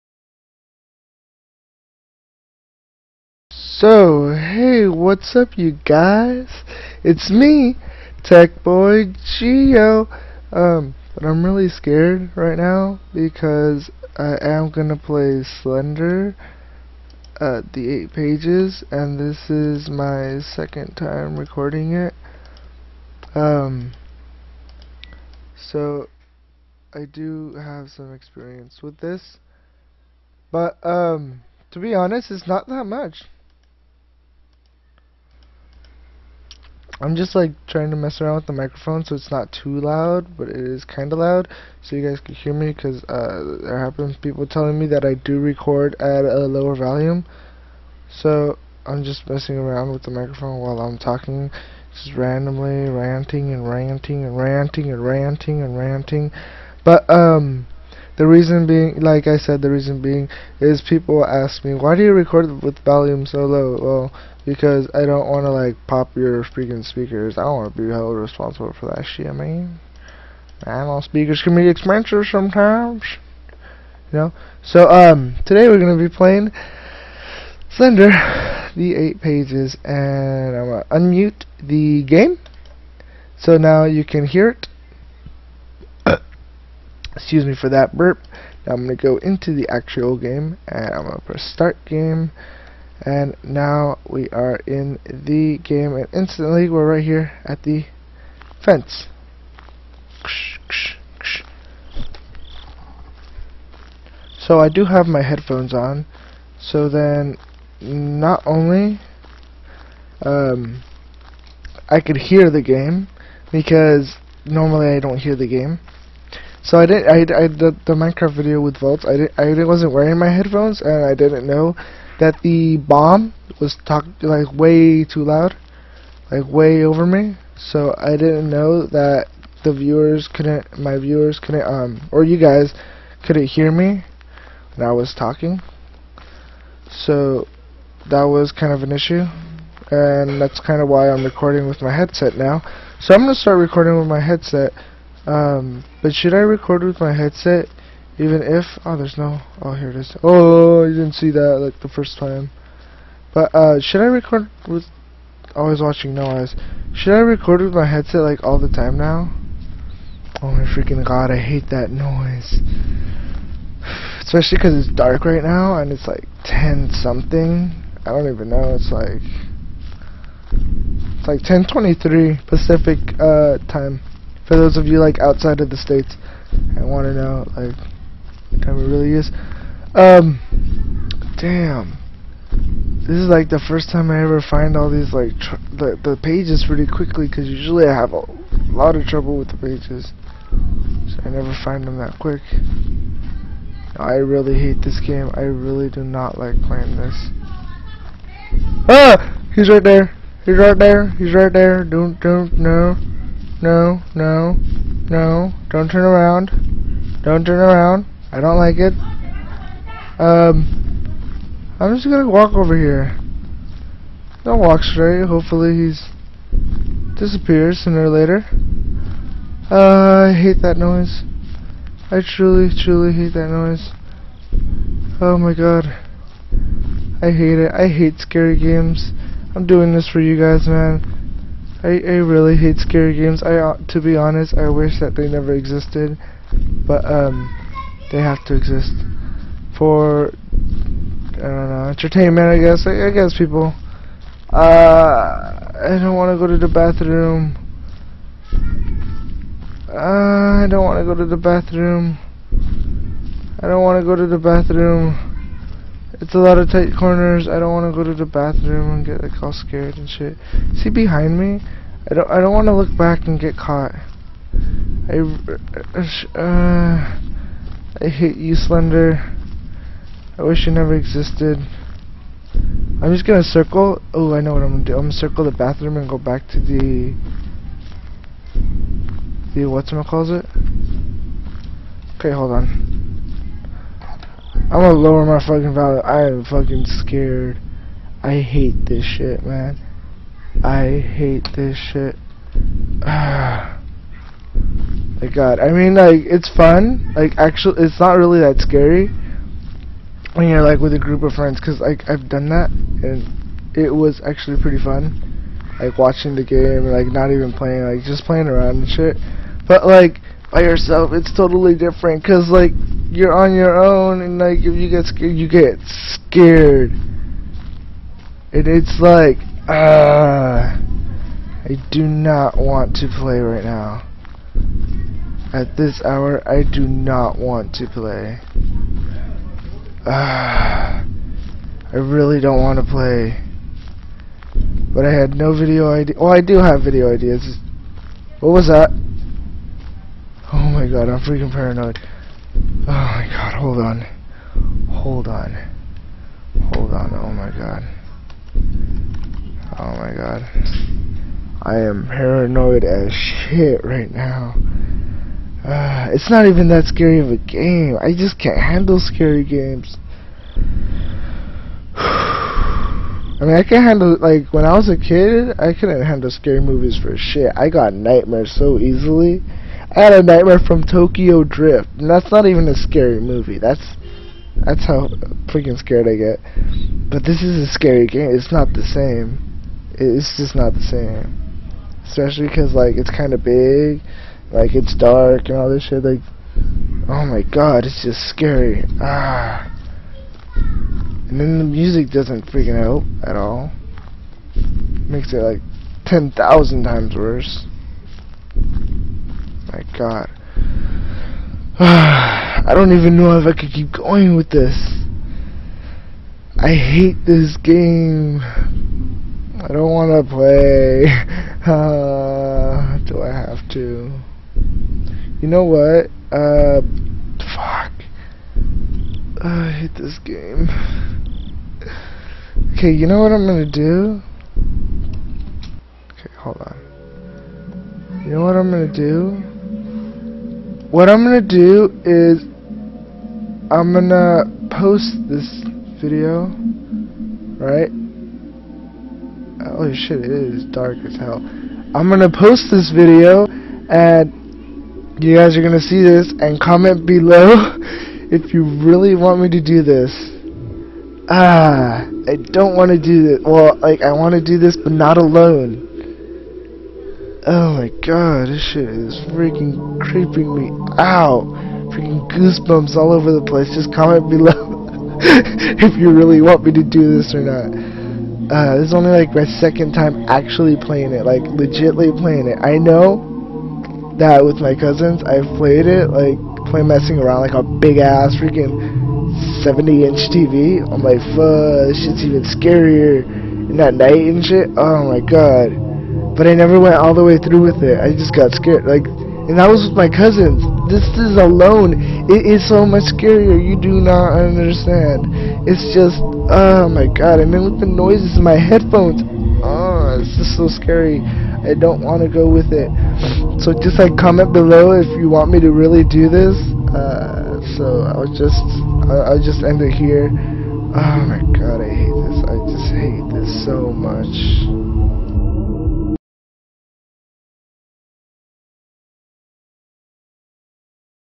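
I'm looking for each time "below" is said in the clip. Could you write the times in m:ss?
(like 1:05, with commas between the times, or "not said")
7:27, 7:44, 8:24.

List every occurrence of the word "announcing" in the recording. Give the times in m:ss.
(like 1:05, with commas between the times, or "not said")
not said.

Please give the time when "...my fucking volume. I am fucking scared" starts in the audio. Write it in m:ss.
4:45.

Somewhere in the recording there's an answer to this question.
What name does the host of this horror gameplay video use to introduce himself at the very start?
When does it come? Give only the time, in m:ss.
0:08.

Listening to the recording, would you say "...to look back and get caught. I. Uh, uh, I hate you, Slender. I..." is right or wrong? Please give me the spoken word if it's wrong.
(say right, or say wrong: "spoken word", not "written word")
right.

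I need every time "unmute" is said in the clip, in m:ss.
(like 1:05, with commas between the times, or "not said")
1:20.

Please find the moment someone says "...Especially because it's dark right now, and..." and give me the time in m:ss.
2:44.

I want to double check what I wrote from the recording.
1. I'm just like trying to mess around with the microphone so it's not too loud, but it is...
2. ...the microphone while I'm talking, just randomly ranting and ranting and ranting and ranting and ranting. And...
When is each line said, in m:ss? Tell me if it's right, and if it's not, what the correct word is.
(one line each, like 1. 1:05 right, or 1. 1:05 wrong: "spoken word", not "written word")
1. 0:37 right
2. 0:50 right.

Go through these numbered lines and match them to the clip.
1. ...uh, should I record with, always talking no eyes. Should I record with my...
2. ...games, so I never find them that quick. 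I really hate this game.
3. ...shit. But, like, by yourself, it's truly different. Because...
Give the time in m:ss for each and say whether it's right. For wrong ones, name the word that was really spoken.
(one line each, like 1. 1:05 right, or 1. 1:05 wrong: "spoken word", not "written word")
1. 2:33 wrong: "watching", not "talking"
2. 3:09 wrong: "pages", not "games"
3. 5:08 wrong: "totally", not "truly".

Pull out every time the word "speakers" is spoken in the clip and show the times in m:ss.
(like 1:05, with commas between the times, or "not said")
1:06, 1:11.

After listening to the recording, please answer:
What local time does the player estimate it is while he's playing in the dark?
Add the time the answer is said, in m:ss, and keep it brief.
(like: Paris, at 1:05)
10:23, at 2:51.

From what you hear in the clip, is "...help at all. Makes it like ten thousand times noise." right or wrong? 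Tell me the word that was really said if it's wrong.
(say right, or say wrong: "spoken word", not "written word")
wrong: "worse", not "noise".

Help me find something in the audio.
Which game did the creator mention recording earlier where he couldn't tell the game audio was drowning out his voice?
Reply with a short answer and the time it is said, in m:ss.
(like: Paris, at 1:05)
Minecraft, at 1:57.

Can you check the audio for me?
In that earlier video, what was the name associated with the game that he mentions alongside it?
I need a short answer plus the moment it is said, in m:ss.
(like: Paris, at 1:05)
Vaults, at 1:58.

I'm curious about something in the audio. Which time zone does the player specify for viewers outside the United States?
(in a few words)
Pacific.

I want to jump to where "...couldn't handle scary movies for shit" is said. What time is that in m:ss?
6:05.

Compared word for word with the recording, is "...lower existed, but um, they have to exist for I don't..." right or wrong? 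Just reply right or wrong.
wrong.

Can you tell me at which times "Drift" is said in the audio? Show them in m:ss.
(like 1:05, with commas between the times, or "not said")
6:11.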